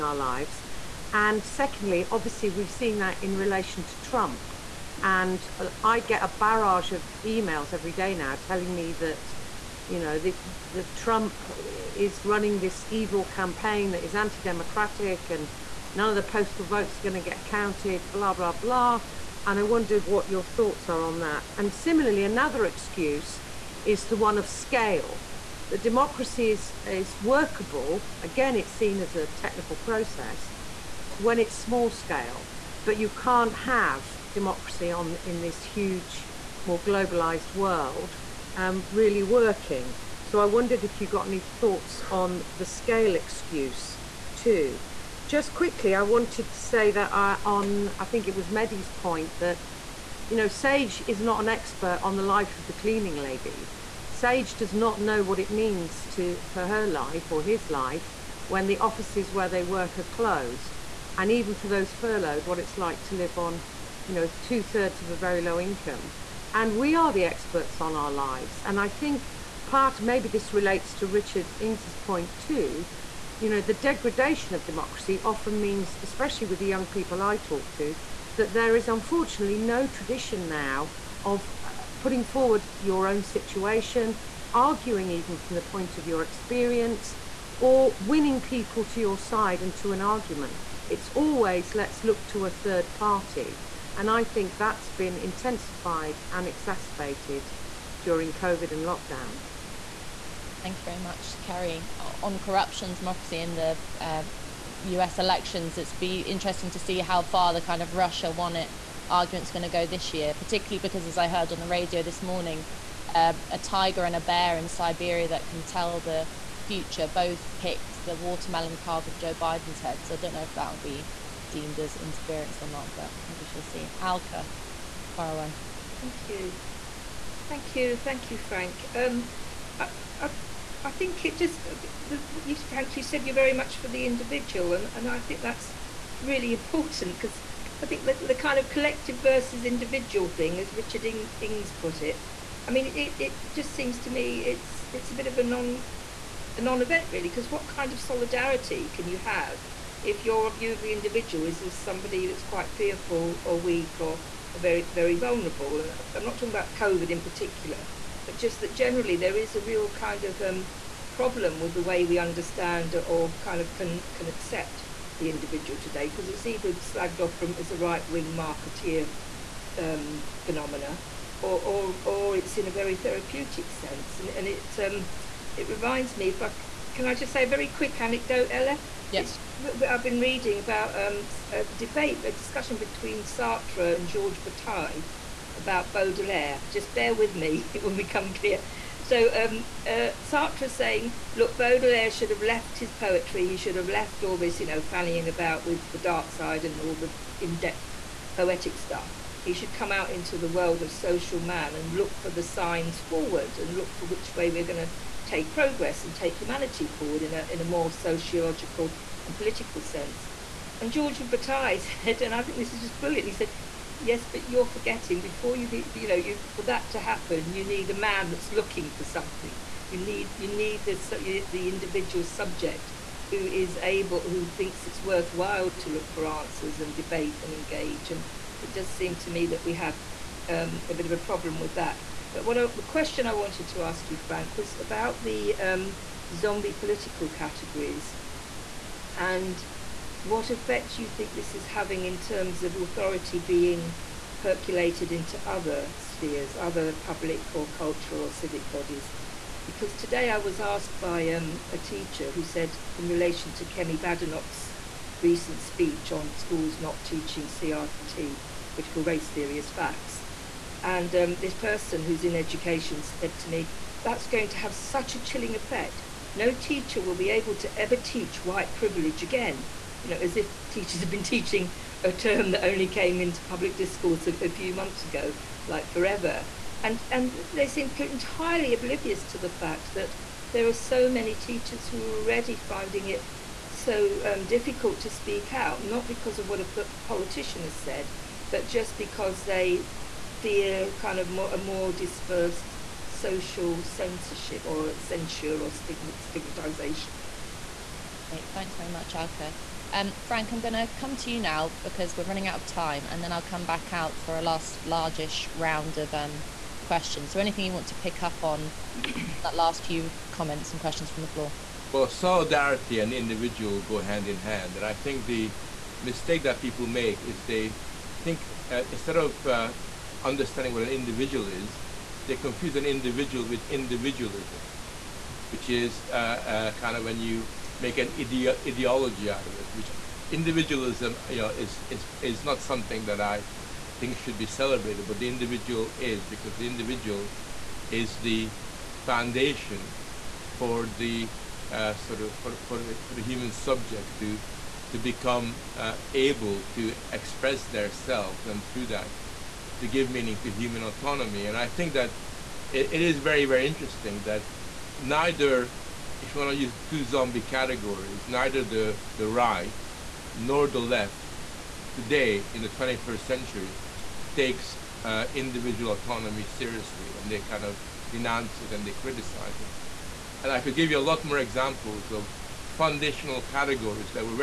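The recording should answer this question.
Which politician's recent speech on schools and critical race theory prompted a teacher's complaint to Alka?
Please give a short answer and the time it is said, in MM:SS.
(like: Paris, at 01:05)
Kemi Badenoch, at 04:13.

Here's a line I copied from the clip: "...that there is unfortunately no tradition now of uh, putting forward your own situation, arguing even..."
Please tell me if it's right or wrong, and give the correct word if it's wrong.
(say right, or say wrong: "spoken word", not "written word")
right.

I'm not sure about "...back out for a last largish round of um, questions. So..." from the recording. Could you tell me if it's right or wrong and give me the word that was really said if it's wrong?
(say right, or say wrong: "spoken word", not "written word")
right.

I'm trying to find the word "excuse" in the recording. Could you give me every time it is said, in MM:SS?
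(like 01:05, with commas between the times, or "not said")
00:22, 00:43.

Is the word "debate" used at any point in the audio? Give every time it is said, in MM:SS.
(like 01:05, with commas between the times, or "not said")
03:01, 03:46.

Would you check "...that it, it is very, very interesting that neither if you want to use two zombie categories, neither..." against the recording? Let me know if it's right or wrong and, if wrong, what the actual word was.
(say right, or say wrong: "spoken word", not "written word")
right.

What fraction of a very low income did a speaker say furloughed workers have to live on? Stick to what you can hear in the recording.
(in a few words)
two thirds.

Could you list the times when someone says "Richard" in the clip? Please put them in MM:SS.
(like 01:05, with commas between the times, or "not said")
01:11, 02:20.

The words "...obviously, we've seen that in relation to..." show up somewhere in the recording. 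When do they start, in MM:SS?
00:02.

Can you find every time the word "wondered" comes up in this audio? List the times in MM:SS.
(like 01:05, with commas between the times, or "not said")
00:19, 00:40.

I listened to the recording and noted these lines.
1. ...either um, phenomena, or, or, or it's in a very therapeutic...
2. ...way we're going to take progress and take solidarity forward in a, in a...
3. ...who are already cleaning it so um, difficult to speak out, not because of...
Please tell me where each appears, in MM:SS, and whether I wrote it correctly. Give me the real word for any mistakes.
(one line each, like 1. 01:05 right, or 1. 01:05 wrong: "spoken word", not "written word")
1. 02:48 wrong: "marketeer", not "either"
2. 03:24 wrong: "humanity", not "solidarity"
3. 04:41 wrong: "finding", not "cleaning".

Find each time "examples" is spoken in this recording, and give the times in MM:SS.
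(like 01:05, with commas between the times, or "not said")
06:11.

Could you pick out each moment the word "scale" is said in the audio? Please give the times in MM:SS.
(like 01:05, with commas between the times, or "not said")
00:24, 00:31, 00:42.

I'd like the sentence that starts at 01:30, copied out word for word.
It's always let's look to a third party.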